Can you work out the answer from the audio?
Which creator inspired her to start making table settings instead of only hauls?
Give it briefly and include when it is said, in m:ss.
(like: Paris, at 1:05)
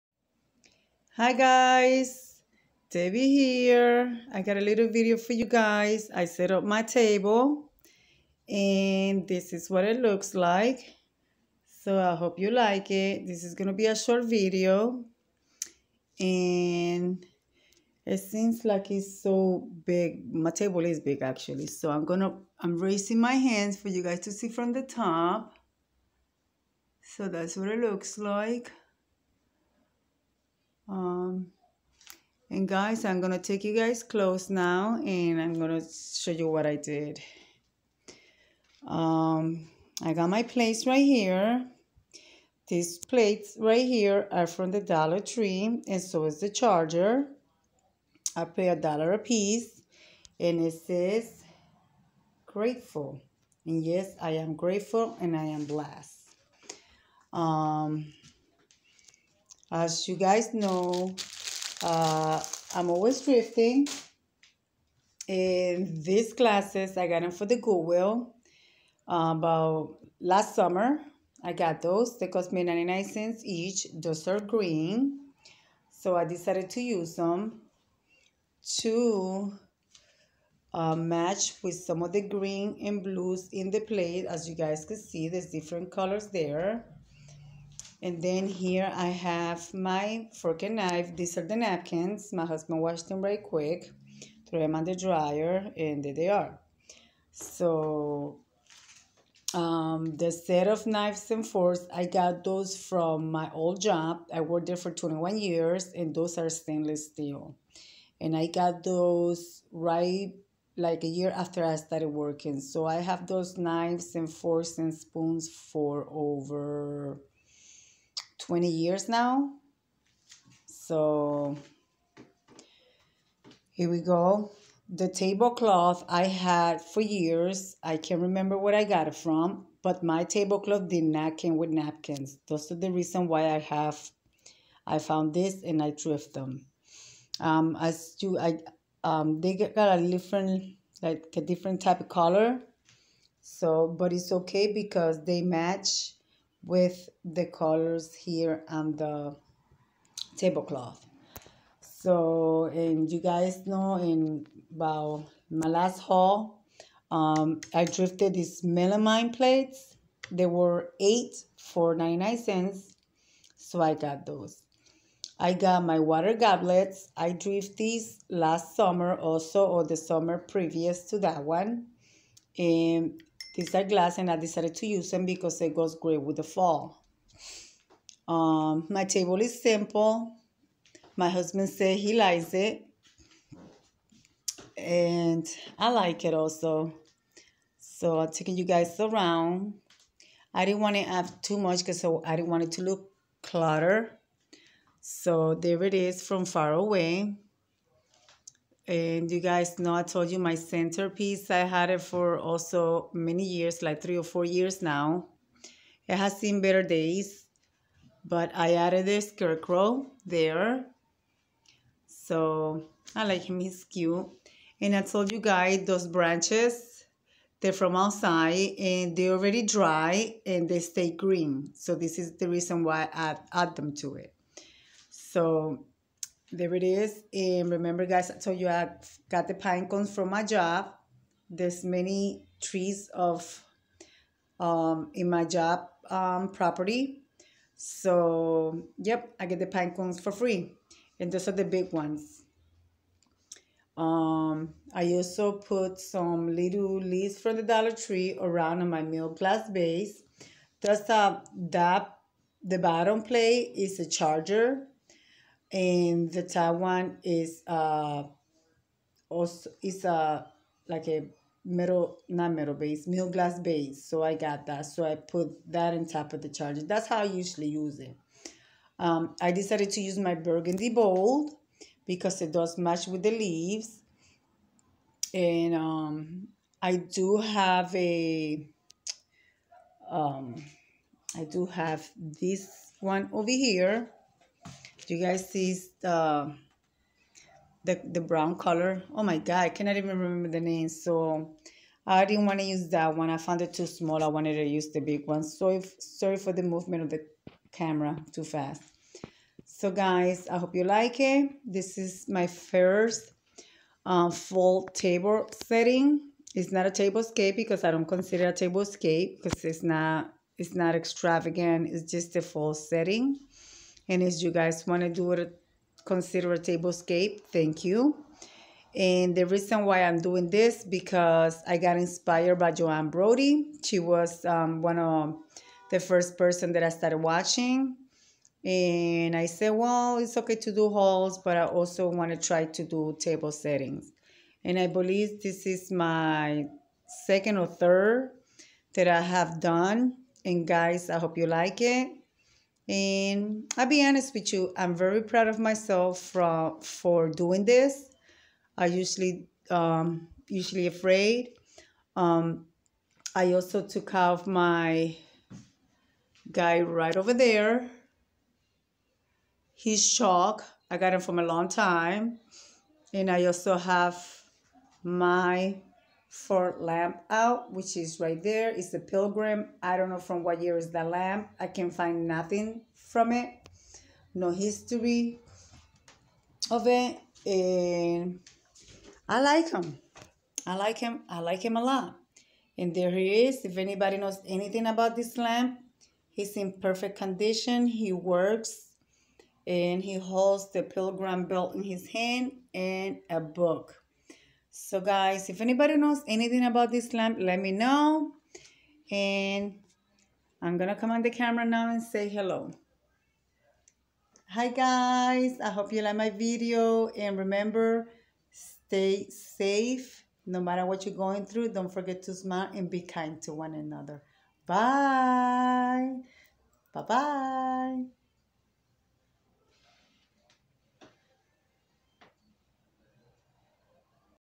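Joanne Brody, at 5:22.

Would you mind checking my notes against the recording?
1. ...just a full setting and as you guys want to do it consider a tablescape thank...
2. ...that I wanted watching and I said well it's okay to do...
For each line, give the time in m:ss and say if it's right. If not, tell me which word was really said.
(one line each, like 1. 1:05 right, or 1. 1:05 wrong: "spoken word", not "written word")
1. 5:12 right
2. 5:26 wrong: "started", not "wanted".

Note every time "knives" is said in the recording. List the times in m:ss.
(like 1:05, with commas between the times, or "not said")
1:40, 1:53.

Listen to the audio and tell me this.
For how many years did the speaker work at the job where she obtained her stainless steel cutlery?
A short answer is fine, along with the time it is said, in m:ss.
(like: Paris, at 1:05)
21 years, at 1:44.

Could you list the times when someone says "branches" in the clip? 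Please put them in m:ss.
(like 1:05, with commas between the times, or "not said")
3:36.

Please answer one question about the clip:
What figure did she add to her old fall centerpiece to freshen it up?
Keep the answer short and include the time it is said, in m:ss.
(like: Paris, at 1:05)
scarecrow, at 3:29.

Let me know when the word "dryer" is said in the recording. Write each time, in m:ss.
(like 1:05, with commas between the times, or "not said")
1:34.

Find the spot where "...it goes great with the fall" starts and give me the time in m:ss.
2:55.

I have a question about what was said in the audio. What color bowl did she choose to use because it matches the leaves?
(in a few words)
burgundy.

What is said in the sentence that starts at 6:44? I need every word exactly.
Hi guys, I hope you like my video.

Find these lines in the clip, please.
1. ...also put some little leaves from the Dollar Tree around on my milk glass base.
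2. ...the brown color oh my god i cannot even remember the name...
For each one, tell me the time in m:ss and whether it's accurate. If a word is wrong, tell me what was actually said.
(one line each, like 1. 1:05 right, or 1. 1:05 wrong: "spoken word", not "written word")
1. 4:05 right
2. 4:48 right.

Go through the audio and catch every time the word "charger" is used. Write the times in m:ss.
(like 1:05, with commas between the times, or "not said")
0:46, 4:14, 4:26.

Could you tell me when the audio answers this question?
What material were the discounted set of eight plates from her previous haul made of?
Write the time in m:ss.
2:38.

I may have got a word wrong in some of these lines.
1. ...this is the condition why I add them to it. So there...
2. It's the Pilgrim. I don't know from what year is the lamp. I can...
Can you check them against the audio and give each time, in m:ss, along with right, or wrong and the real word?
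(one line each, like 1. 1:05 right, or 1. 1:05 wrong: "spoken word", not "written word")
1. 3:41 wrong: "reason", not "condition"
2. 6:08 right.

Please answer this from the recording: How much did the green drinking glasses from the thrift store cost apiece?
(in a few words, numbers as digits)
99 cents.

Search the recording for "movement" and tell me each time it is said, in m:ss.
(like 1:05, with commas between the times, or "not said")
4:56.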